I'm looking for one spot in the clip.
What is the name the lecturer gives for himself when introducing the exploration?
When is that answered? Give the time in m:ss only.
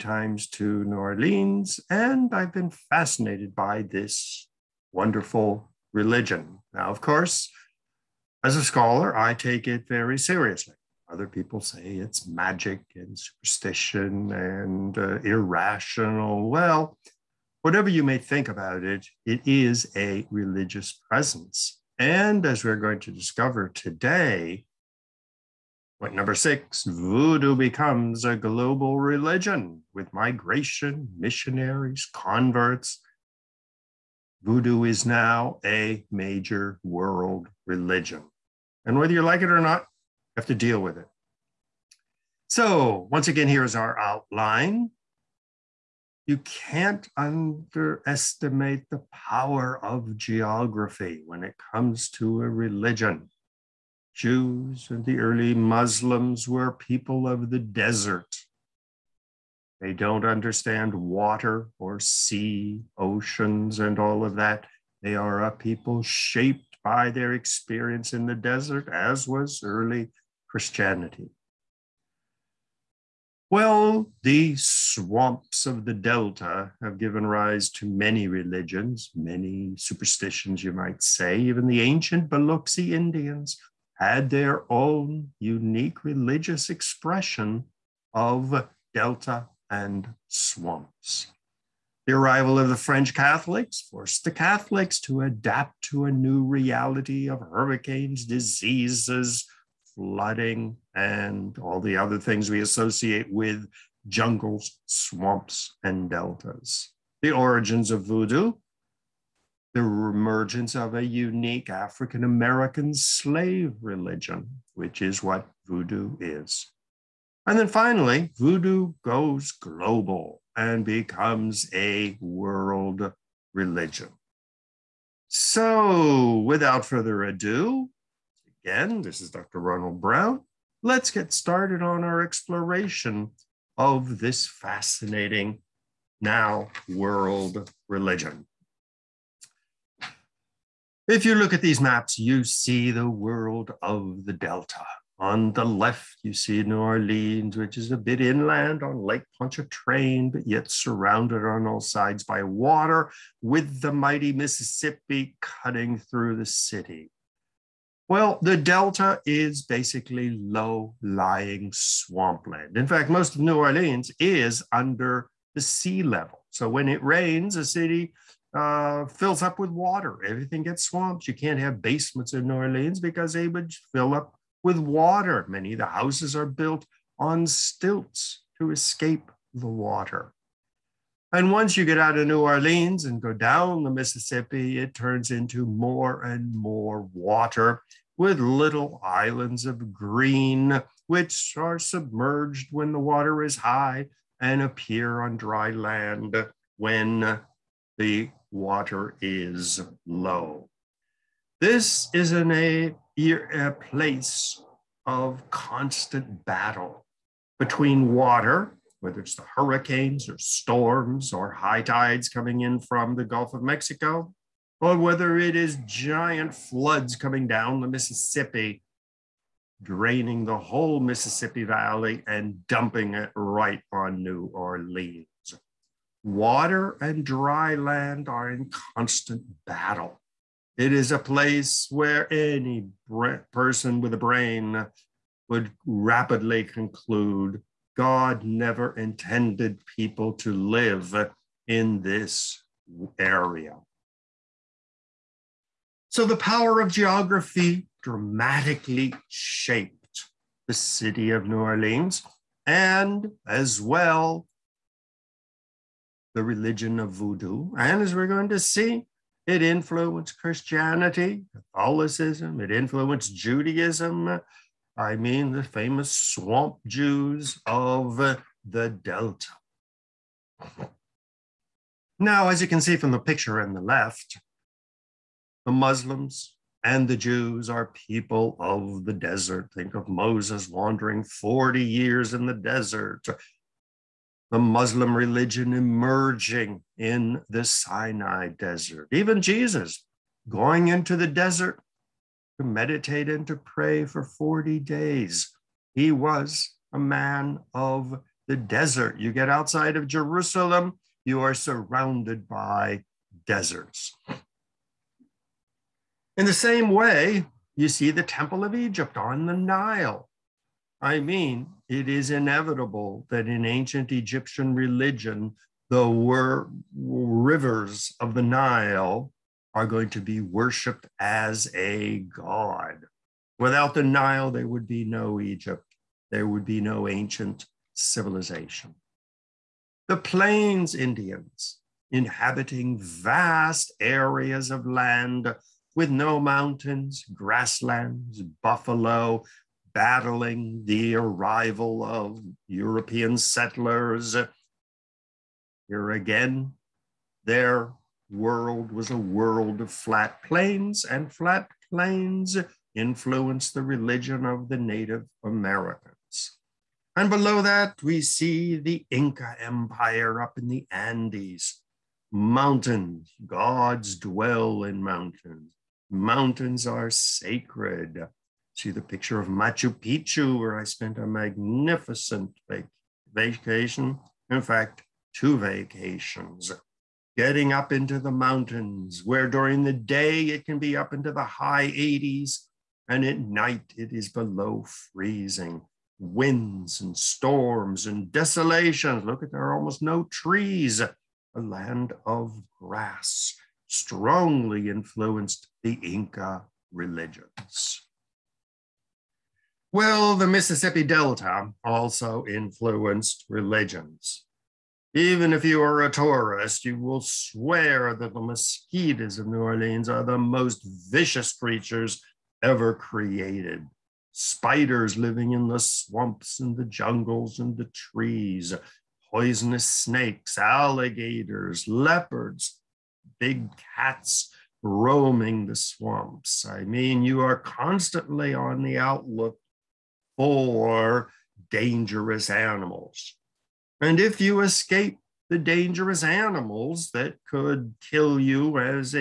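2:09.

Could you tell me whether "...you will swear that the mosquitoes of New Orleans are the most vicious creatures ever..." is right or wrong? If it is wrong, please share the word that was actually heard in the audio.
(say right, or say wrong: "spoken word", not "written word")
right.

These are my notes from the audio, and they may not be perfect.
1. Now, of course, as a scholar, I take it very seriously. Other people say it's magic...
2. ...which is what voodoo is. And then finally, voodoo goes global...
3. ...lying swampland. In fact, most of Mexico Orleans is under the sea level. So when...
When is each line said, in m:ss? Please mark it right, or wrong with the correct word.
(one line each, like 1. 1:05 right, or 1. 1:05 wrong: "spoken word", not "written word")
1. 0:06 right
2. 1:54 right
3. 2:41 wrong: "New", not "Mexico".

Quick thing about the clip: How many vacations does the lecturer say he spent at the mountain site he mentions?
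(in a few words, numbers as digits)
2.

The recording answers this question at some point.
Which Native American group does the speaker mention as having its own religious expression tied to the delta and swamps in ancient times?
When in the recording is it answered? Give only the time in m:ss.
1:22.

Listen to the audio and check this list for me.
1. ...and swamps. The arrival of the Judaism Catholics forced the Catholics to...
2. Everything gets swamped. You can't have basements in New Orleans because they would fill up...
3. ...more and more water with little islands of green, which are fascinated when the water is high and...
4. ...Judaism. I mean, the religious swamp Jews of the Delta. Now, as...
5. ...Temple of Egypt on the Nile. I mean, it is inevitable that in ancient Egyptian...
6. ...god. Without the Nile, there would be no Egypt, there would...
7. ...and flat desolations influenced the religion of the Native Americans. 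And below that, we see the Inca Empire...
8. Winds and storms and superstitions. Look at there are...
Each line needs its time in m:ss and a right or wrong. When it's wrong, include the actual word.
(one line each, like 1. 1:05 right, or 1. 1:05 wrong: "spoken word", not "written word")
1. 1:29 wrong: "French", not "Judaism"
2. 2:50 right
3. 3:05 wrong: "submerged", not "fascinated"
4. 4:23 wrong: "famous", not "religious"
5. 5:08 right
6. 5:22 right
7. 5:51 wrong: "plains", not "desolations"
8. 6:26 wrong: "desolations", not "superstitions".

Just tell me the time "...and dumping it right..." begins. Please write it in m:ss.
3:42.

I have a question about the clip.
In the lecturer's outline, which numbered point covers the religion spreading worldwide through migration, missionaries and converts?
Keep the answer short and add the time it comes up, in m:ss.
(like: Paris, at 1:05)
6, at 0:26.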